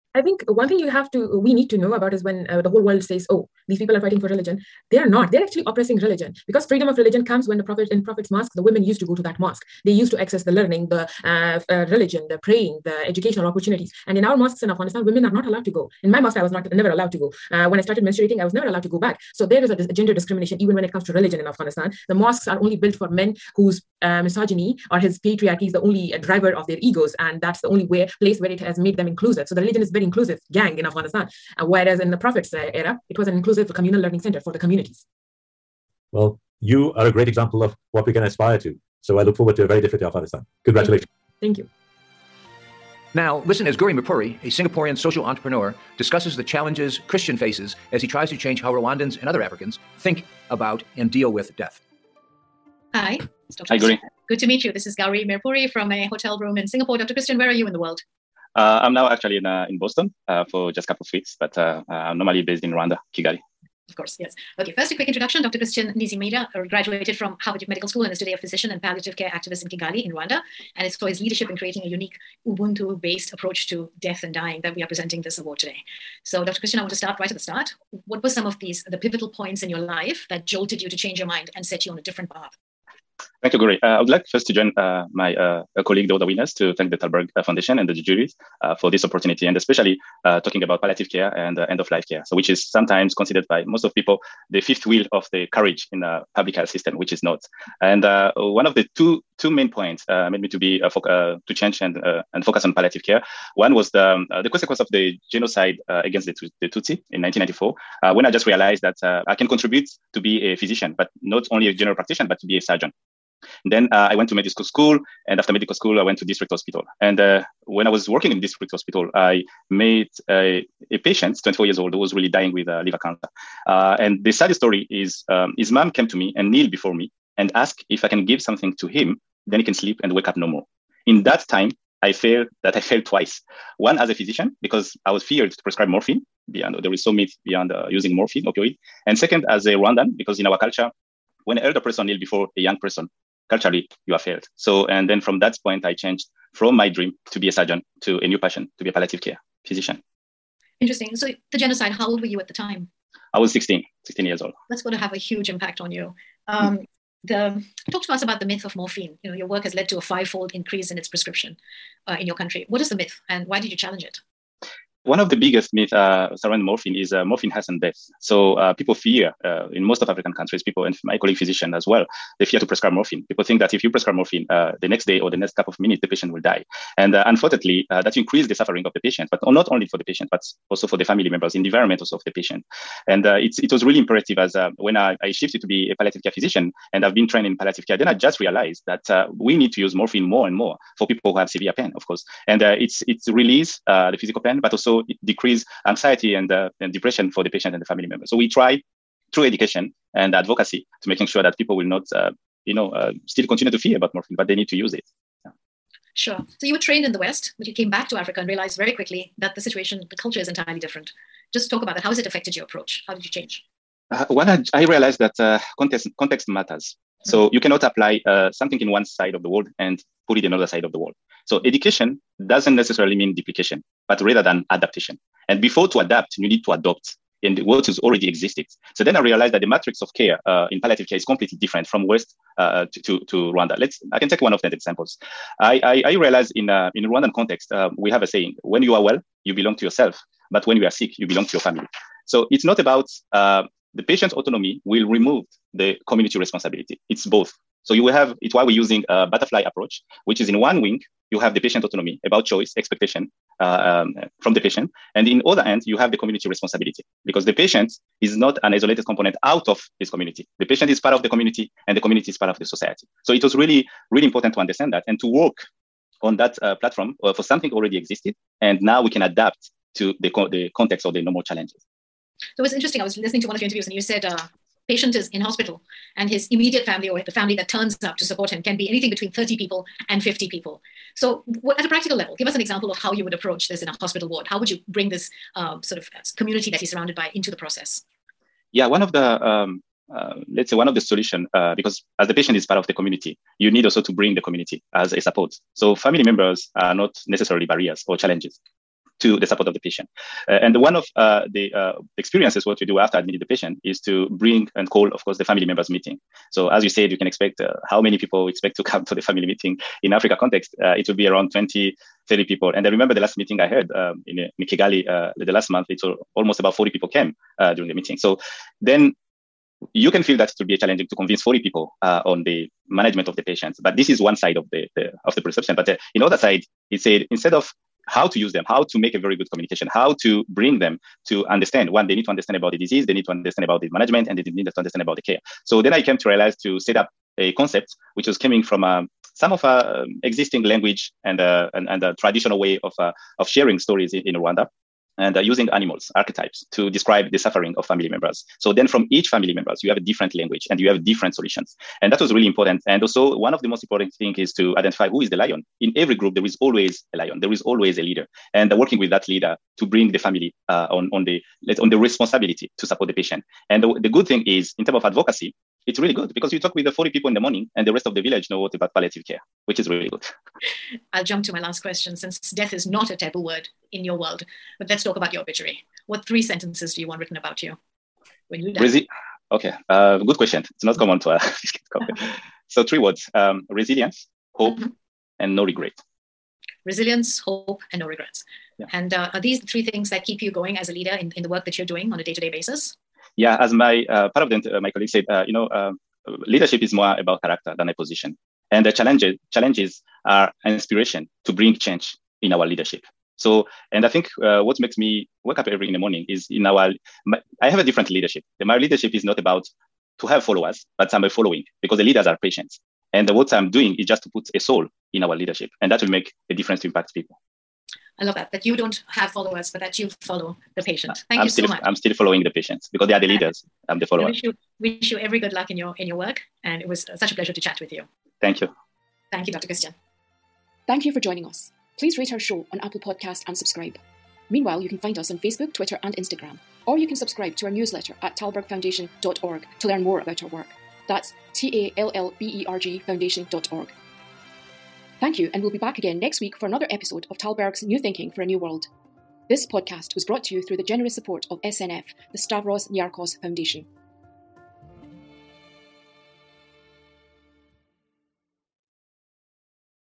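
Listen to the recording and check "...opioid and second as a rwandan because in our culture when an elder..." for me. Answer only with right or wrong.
right.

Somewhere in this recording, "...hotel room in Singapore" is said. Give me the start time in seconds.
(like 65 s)
56 s.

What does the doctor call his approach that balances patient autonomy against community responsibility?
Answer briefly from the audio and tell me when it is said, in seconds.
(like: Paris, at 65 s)
Butterfly approach, at 249 s.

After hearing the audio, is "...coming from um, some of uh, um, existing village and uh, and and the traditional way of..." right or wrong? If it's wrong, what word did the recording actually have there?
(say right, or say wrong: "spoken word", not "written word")
wrong: "language", not "village".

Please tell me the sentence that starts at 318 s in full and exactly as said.
So then you can feel that it will be challenging to convince 40 people uh, on the management of the patients.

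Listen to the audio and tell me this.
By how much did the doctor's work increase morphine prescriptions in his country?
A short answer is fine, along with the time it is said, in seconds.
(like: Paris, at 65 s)
Five-fold, at 160 s.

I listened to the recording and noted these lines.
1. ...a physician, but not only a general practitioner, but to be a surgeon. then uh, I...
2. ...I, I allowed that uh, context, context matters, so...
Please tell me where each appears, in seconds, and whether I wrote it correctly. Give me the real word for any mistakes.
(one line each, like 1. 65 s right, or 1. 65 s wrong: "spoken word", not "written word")
1. 110 s right
2. 214 s wrong: "realized", not "allowed".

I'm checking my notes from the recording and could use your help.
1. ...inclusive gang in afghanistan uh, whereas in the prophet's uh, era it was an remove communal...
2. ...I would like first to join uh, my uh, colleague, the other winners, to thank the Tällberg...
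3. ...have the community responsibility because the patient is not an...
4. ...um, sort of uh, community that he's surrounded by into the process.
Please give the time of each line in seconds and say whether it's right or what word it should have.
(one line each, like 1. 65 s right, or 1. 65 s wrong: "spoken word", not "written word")
1. 30 s wrong: "inclusive", not "remove"
2. 83 s right
3. 255 s right
4. 285 s right.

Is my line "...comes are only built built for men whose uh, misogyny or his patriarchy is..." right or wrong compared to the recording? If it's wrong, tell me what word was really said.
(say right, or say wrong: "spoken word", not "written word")
wrong: "mosques", not "comes".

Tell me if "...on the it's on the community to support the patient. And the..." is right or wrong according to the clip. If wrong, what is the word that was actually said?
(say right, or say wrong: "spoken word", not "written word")
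wrong: "responsibility", not "community".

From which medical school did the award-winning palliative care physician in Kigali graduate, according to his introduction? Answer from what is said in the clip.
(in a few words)
Harvard Medical School.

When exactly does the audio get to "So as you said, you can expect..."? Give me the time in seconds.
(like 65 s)
306 s.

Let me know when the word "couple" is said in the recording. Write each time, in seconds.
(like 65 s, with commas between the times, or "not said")
60 s, 175 s.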